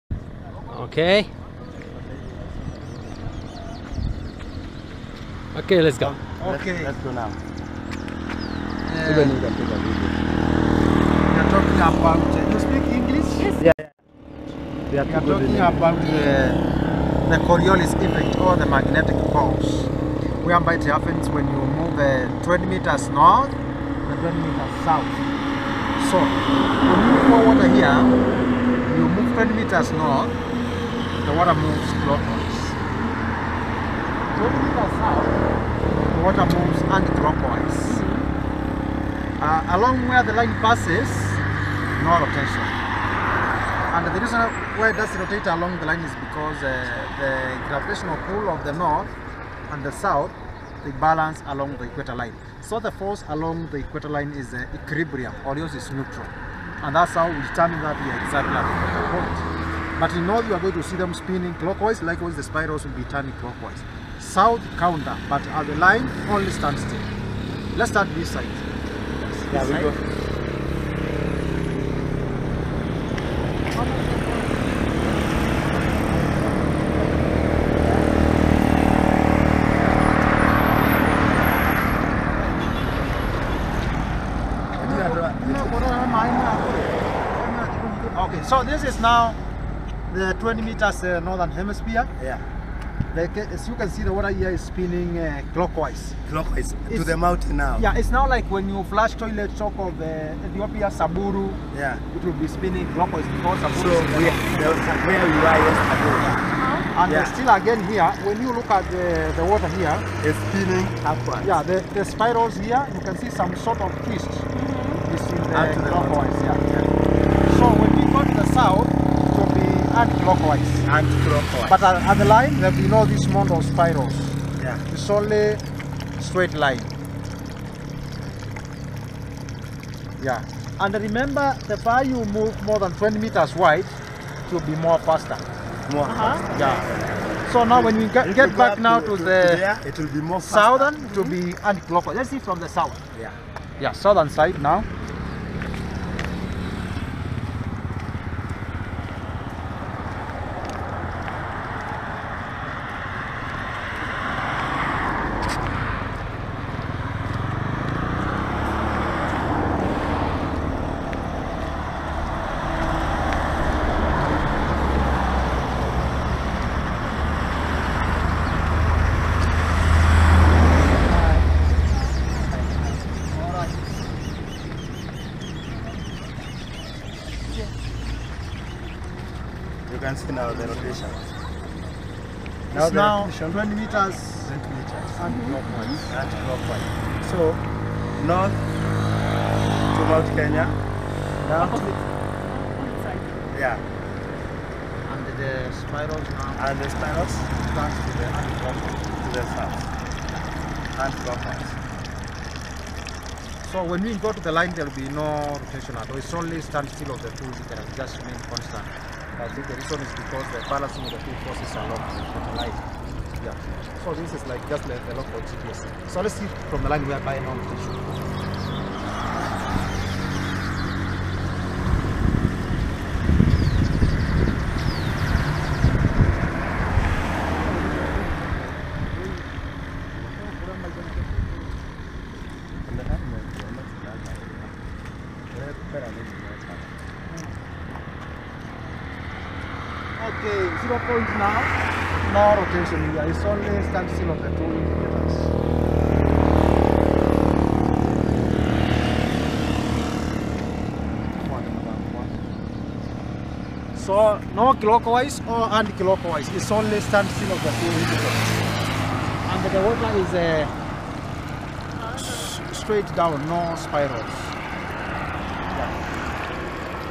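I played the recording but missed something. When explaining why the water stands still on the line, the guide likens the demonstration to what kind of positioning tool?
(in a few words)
local GPS.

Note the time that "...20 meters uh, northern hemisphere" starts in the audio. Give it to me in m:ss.
1:30.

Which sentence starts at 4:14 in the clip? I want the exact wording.
So no clockwise or oh, anti-clockwise, it's only standstill of the two indicators.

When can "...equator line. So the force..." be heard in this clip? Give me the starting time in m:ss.
0:51.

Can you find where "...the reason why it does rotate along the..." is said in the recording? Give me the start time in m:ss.
0:44.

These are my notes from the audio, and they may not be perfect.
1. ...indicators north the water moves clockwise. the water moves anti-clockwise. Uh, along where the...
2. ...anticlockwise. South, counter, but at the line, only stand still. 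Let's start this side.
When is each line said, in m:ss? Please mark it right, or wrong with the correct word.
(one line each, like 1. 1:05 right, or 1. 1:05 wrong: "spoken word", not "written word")
1. 0:29 wrong: "meters", not "indicators"
2. 1:03 wrong: "clockwise", not "anticlockwise".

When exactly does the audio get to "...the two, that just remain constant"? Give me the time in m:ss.
3:27.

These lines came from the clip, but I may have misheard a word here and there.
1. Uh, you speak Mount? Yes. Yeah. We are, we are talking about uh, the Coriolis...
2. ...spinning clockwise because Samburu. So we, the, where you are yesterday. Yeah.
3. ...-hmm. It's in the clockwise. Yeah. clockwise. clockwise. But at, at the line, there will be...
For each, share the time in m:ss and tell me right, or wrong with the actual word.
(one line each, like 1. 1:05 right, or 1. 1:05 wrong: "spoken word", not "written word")
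1. 0:12 wrong: "English", not "Mount"
2. 1:42 right
3. 1:54 right.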